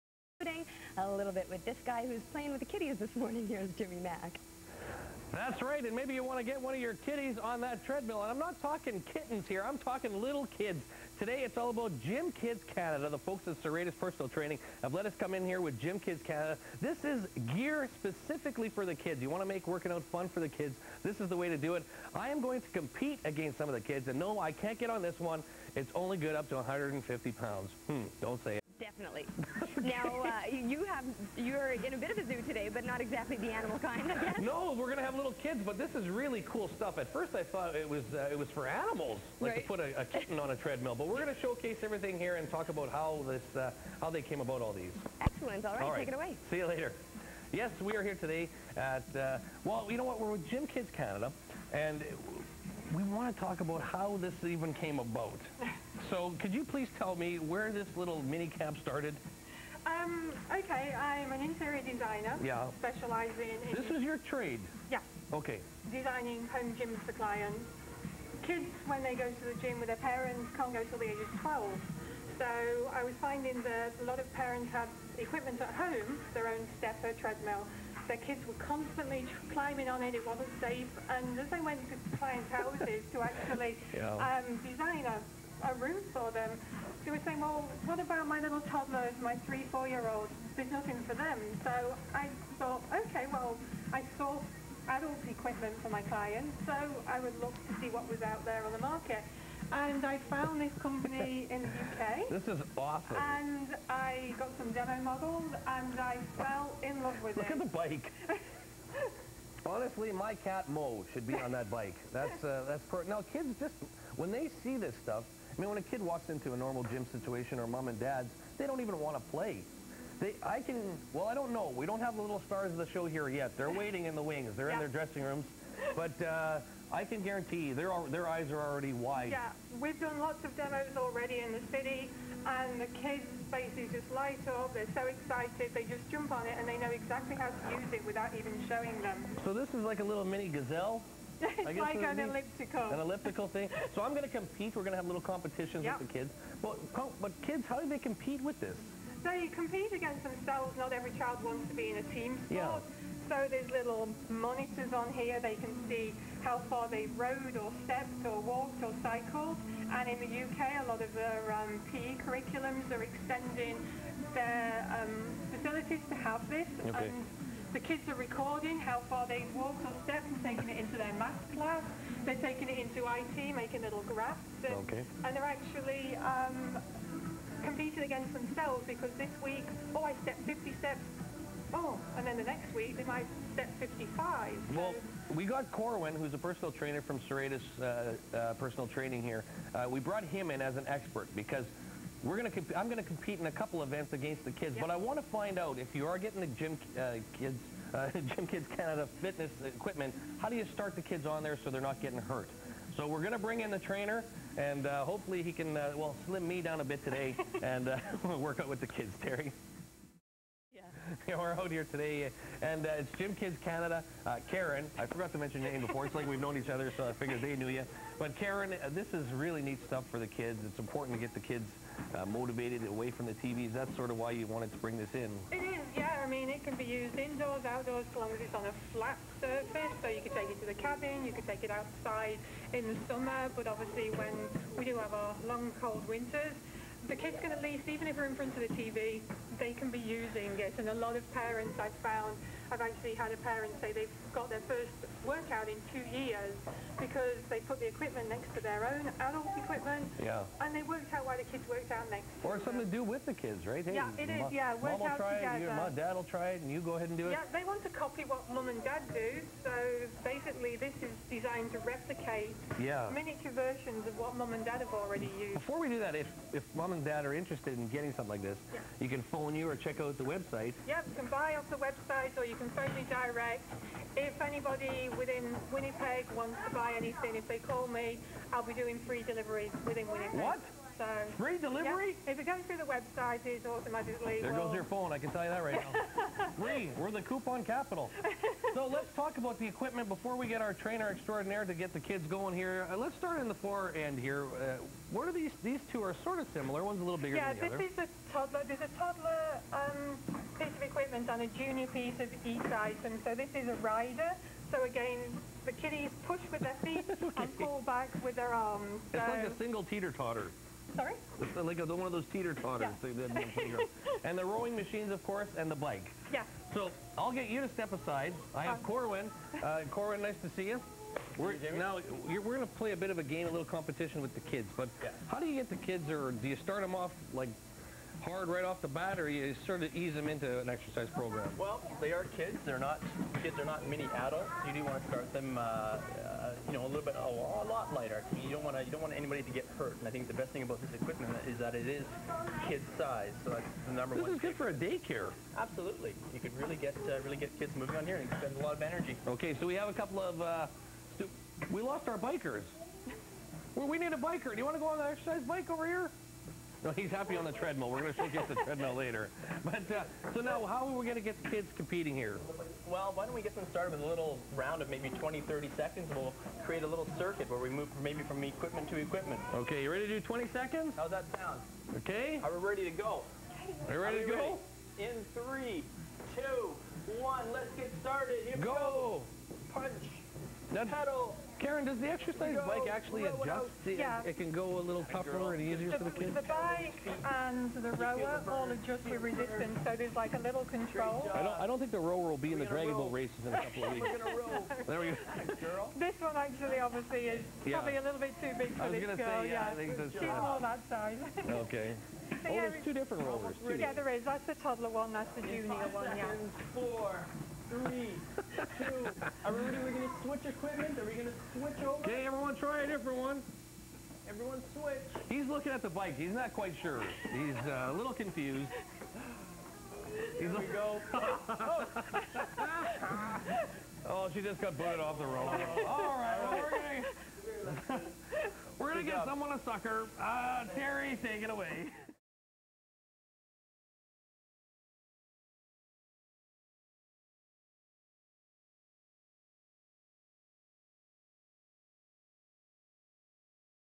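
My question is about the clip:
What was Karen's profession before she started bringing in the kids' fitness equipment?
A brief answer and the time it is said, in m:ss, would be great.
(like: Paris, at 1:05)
Interior designer, at 1:01.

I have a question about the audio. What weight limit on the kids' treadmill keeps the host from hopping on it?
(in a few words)
150 pounds.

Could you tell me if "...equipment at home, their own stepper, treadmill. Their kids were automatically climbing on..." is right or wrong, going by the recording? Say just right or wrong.
wrong.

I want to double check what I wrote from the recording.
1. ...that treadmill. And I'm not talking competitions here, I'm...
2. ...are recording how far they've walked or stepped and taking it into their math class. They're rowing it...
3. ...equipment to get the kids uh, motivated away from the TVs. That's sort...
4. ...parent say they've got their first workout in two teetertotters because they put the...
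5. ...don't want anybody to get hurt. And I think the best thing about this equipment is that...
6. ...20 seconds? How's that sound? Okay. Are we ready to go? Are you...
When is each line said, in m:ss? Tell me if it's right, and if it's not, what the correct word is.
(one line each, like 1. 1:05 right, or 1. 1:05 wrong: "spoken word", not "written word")
1. 0:07 wrong: "kittens", not "competitions"
2. 2:48 wrong: "taking", not "rowing"
3. 3:40 wrong: "important", not "equipment"
4. 4:03 wrong: "years", not "teetertotters"
5. 5:38 right
6. 6:10 right.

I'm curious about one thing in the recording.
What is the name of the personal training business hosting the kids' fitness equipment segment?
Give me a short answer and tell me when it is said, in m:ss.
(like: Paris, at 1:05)
Serratus Personal Training, at 0:13.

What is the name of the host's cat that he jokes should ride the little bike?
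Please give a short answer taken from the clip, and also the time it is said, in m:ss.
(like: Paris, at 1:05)
Mo, at 1:50.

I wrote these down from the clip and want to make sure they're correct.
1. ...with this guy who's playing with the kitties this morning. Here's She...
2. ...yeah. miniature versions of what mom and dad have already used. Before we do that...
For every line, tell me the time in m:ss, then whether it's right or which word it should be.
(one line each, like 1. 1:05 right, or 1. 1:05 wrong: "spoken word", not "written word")
1. 0:01 wrong: "Jimmy", not "She"
2. 4:22 right.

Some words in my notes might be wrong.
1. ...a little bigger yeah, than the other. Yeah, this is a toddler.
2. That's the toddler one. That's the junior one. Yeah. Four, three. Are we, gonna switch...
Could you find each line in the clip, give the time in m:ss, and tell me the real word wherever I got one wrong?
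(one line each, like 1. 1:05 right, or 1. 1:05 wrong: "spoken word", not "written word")
1. 4:57 right
2. 6:44 right.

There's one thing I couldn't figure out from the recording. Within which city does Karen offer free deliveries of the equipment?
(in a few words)
Winnipeg.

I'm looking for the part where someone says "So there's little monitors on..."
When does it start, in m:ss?
2:33.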